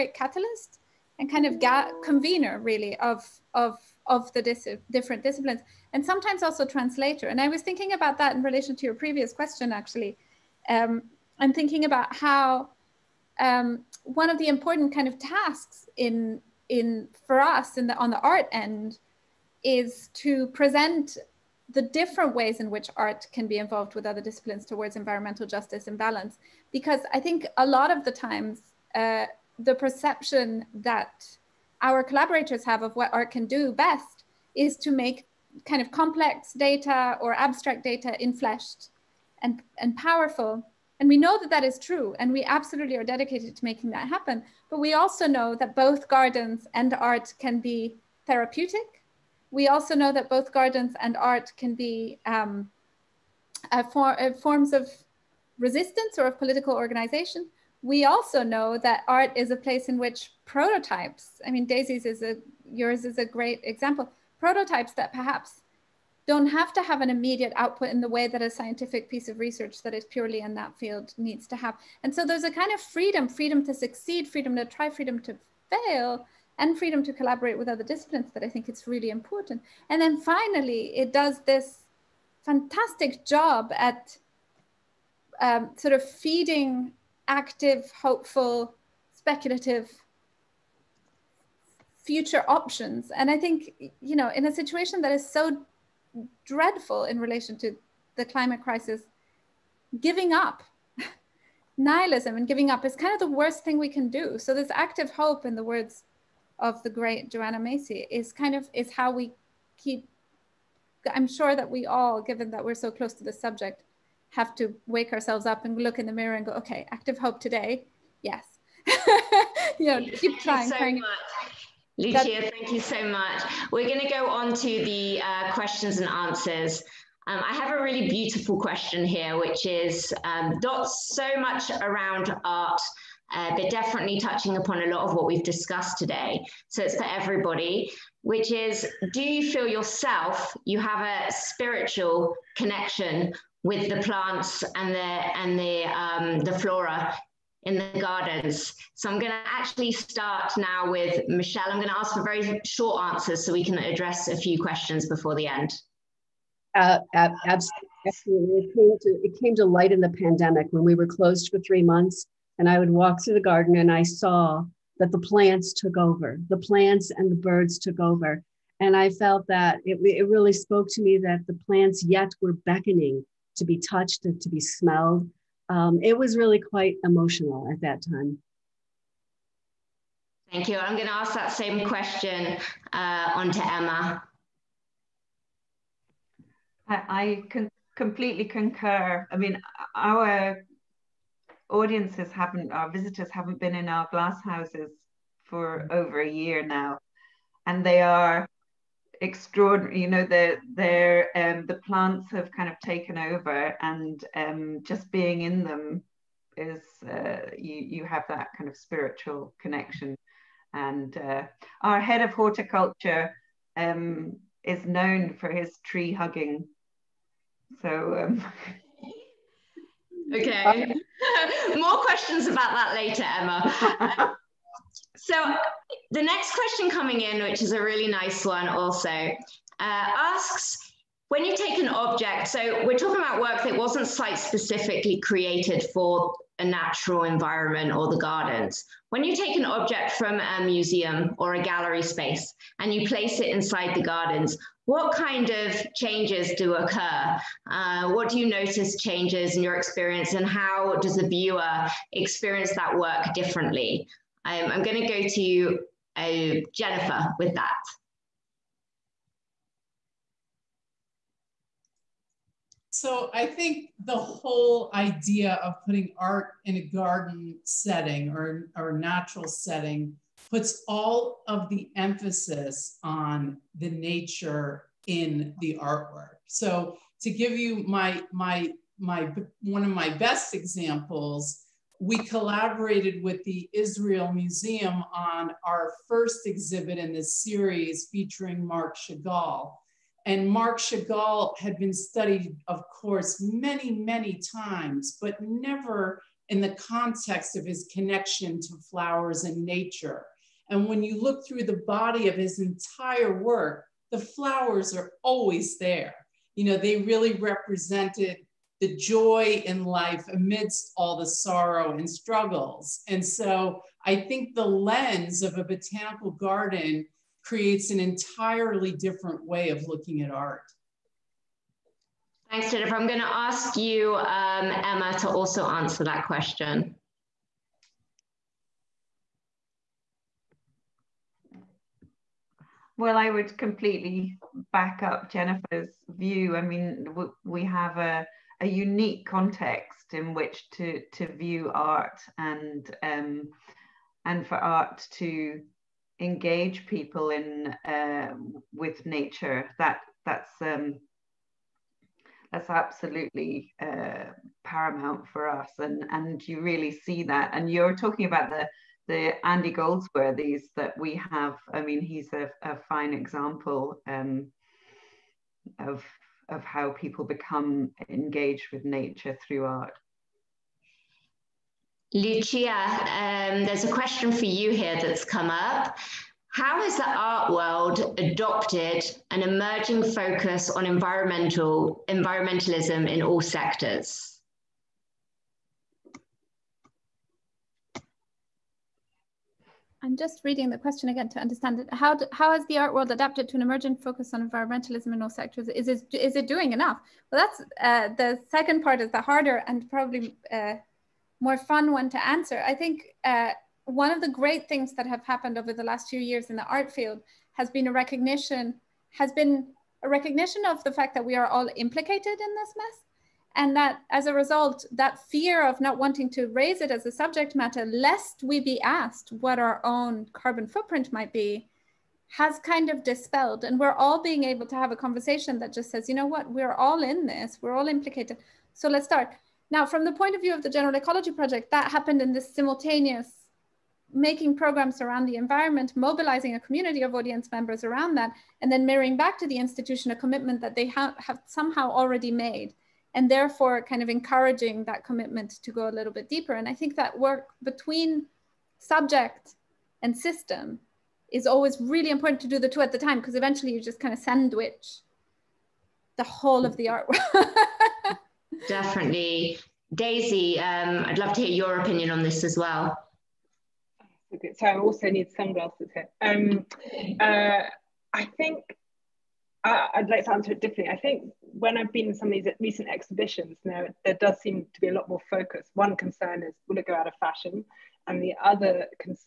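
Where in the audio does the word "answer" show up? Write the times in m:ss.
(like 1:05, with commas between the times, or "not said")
2:06, 2:33, 5:25, 6:42, 7:50.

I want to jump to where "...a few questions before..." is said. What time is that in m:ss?
2:34.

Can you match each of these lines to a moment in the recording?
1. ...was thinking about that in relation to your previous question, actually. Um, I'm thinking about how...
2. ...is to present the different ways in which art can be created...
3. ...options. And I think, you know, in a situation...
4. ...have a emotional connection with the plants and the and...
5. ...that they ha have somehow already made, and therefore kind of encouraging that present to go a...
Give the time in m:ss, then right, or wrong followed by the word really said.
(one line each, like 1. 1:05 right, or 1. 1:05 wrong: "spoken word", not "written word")
1. 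0:07 right
2. 0:19 wrong: "involved", not "created"
3. 1:32 right
4. 2:20 wrong: "spiritual", not "emotional"
5. 7:20 wrong: "commitment", not "present".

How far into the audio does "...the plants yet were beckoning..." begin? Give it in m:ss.
2:51.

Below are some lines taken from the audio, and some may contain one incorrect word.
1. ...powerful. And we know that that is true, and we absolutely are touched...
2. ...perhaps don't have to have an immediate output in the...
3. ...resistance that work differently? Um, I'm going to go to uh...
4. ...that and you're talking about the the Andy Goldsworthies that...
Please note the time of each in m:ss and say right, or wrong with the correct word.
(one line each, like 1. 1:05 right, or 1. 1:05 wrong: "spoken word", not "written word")
1. 0:39 wrong: "dedicated", not "touched"
2. 1:05 right
3. 4:12 wrong: "experience", not "resistance"
4. 5:57 right.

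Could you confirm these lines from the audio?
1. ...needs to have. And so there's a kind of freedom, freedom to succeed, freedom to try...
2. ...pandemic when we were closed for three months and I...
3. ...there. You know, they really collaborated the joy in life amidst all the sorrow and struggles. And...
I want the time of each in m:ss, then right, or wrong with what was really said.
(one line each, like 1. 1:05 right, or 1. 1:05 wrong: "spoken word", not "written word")
1. 1:11 right
2. 2:40 right
3. 5:05 wrong: "represented", not "collaborated".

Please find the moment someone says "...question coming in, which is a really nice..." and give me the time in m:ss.
3:46.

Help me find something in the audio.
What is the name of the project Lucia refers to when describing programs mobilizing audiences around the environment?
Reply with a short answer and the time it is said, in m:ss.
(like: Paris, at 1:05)
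General Ecology Project, at 7:10.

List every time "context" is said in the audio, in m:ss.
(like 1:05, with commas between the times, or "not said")
4:56, 5:39.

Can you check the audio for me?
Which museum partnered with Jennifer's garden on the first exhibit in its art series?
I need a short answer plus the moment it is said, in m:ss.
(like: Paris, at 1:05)
Israel Museum, at 4:43.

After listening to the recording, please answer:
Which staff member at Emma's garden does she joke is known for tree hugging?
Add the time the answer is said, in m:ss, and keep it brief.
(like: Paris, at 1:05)
head of horticulture, at 3:32.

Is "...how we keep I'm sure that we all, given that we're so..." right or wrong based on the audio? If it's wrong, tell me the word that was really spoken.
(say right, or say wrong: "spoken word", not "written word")
right.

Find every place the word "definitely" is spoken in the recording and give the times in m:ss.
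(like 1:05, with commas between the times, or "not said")
2:13, 7:38.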